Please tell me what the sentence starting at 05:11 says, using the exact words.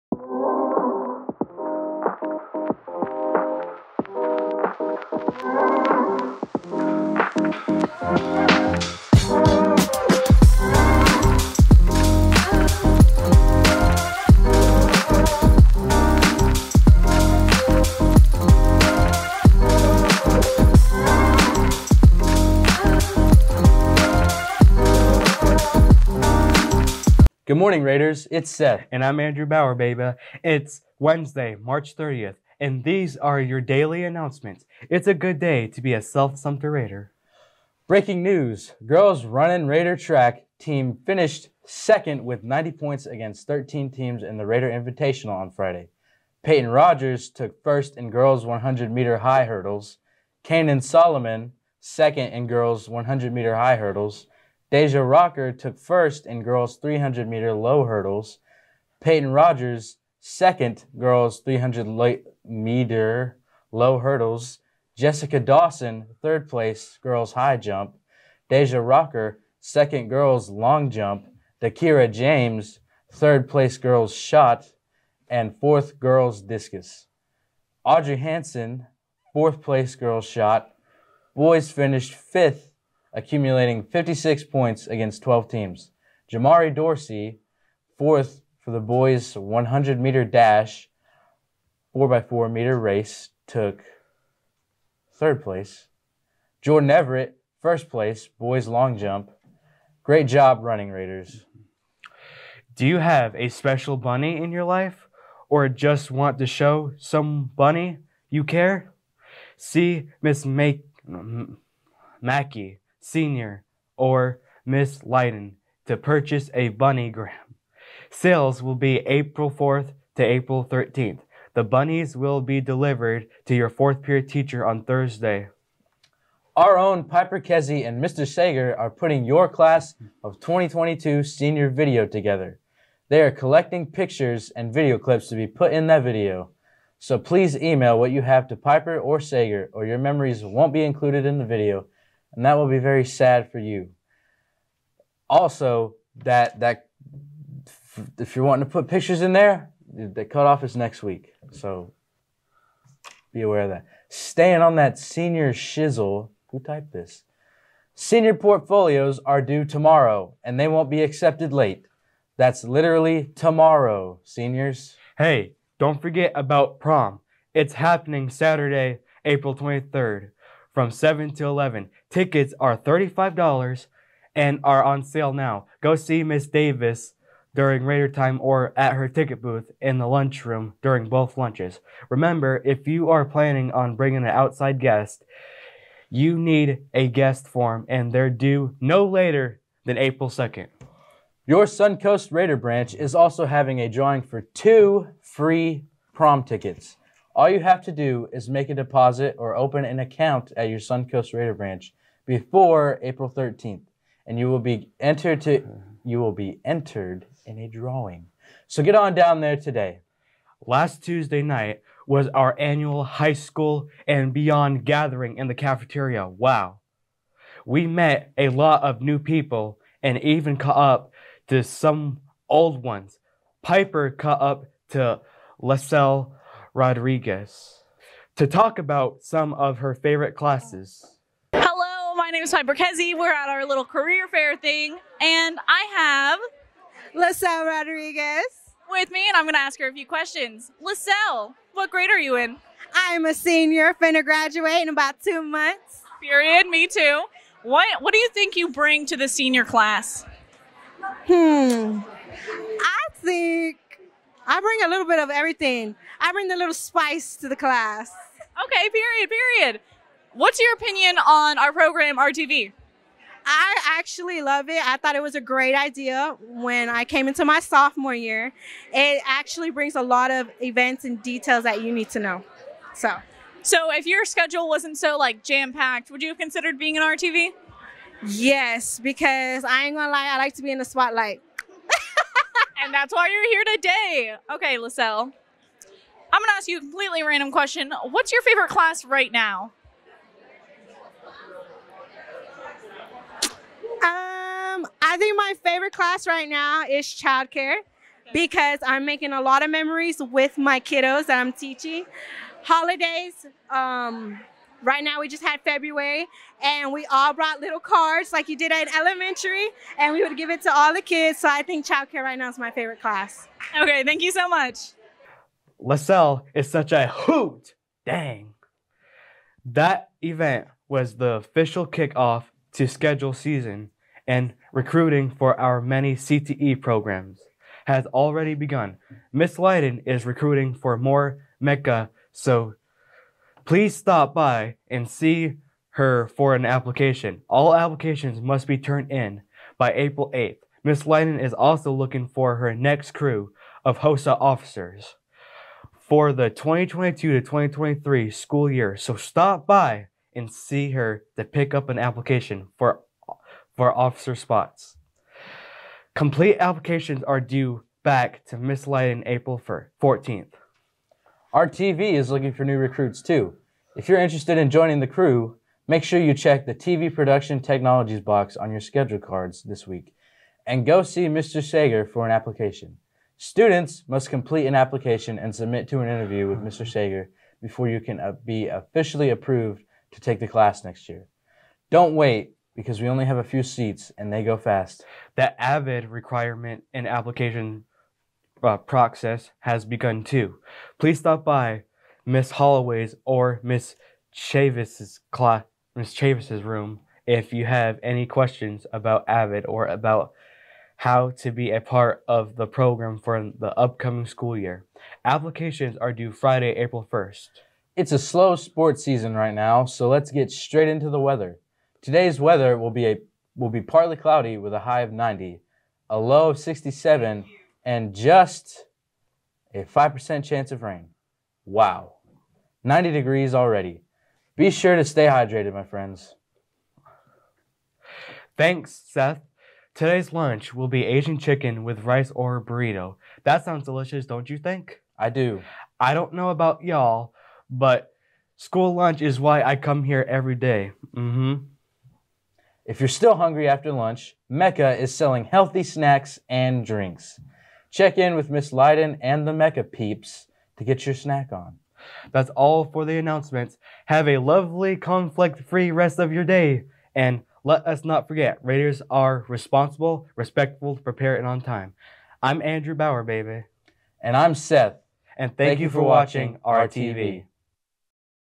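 So I think childcare right now is my favorite class.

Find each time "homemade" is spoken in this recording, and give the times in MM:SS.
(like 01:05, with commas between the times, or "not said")
not said.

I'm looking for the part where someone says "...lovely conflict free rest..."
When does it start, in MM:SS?
07:34.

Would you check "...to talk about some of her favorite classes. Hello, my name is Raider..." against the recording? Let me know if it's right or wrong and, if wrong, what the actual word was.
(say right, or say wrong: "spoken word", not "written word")
wrong: "Piper", not "Raider".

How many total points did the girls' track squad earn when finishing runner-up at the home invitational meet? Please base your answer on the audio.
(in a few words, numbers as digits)
90.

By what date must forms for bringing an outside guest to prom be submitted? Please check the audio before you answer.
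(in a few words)
April 2nd.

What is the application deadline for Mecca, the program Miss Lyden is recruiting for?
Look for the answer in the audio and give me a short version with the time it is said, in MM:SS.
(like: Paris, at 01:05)
April 8th, at 05:39.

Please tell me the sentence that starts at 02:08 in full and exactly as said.
Sager are putting your class of 2022 senior video together.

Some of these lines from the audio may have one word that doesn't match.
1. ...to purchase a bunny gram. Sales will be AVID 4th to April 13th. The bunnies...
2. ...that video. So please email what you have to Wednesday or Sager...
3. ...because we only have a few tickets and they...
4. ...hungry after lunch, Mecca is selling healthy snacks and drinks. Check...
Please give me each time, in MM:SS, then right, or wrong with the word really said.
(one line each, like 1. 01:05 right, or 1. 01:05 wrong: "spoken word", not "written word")
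1. 01:55 wrong: "April", not "AVID"
2. 02:15 wrong: "Piper", not "Wednesday"
3. 06:22 wrong: "seats", not "tickets"
4. 07:23 right.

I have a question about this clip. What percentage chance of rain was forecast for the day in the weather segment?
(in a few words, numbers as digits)
5%.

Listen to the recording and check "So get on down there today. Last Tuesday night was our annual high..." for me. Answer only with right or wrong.
right.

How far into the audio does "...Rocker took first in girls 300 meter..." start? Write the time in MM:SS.
00:55.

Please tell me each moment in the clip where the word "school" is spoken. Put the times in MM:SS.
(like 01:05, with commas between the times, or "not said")
03:33, 05:48, 06:44, 07:18.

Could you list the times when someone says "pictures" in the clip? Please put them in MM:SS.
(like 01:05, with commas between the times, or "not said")
02:13, 02:28.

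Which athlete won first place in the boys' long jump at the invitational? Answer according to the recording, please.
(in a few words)
Jordan Everett.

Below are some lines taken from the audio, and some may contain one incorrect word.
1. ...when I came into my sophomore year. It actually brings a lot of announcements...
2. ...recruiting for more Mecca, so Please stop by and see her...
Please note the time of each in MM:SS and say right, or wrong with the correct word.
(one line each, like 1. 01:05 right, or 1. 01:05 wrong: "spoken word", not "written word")
1. 04:26 wrong: "events", not "announcements"
2. 05:30 right.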